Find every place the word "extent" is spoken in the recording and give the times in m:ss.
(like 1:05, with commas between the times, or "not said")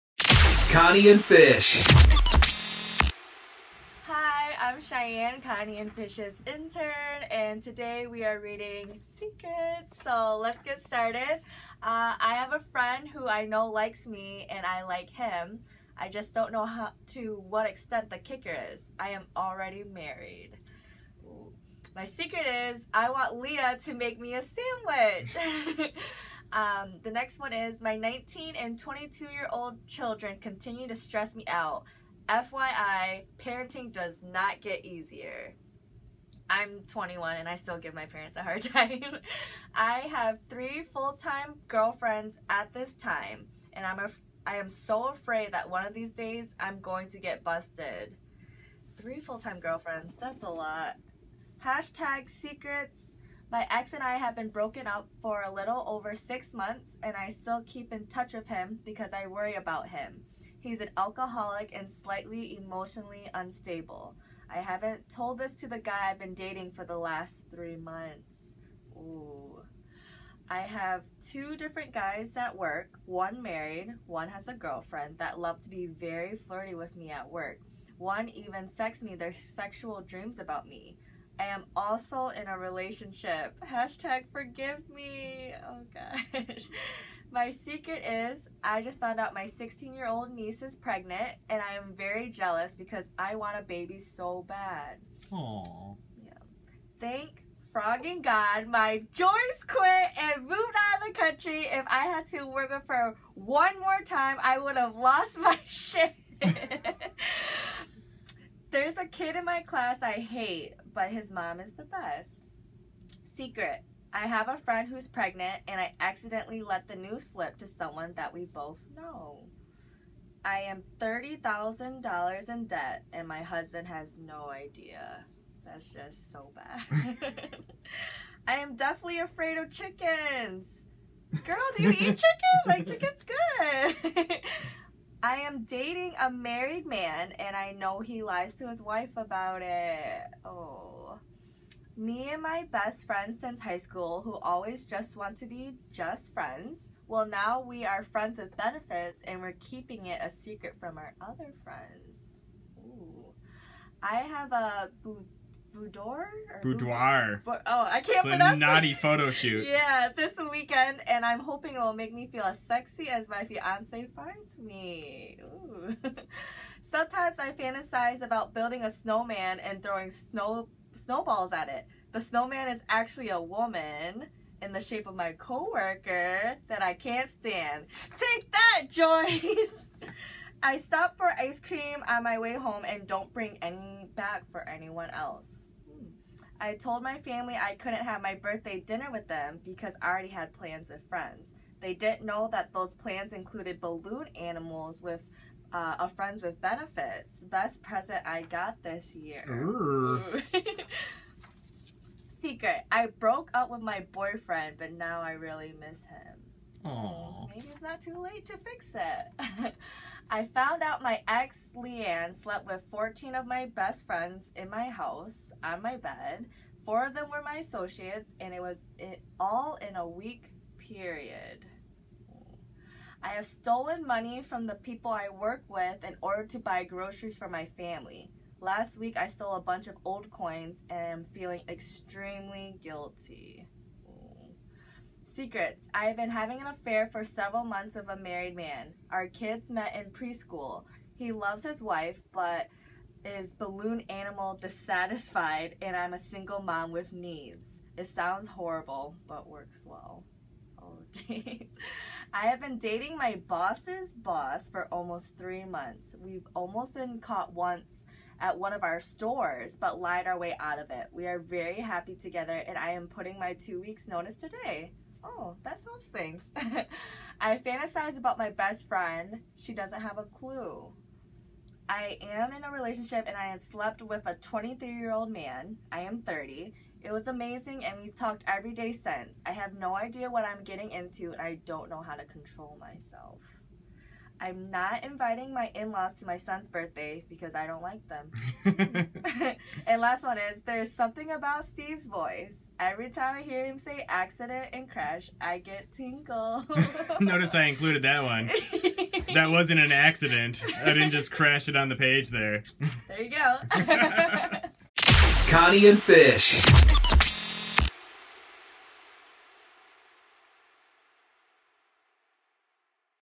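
0:17.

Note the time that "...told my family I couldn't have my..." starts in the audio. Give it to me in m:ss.
3:06.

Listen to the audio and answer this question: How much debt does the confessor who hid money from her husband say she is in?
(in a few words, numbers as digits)
$30,000.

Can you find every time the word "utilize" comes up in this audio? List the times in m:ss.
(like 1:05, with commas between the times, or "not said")
not said.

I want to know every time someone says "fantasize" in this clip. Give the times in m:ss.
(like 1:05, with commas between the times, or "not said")
2:47, 4:27.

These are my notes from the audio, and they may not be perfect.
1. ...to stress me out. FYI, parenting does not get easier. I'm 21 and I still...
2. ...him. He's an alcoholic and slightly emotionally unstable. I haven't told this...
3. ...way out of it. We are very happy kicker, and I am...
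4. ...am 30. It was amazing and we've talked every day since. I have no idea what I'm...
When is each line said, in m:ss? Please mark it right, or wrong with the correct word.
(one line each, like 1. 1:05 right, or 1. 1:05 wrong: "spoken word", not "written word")
1. 0:30 right
2. 0:59 right
3. 4:20 wrong: "together", not "kicker"
4. 4:36 right.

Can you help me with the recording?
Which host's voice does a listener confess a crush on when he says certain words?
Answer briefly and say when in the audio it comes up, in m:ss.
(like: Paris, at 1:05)
Steve, at 4:51.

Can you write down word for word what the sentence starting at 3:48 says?
Last week, I stole a bunch of old coins and am feeling extremely guilty.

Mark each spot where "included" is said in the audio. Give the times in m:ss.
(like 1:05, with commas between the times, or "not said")
3:13, 4:57.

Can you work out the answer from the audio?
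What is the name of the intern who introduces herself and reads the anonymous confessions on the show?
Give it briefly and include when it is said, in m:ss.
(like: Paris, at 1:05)
Cheyenne, at 0:04.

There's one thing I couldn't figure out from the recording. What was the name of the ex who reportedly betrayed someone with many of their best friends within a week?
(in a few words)
Leanne.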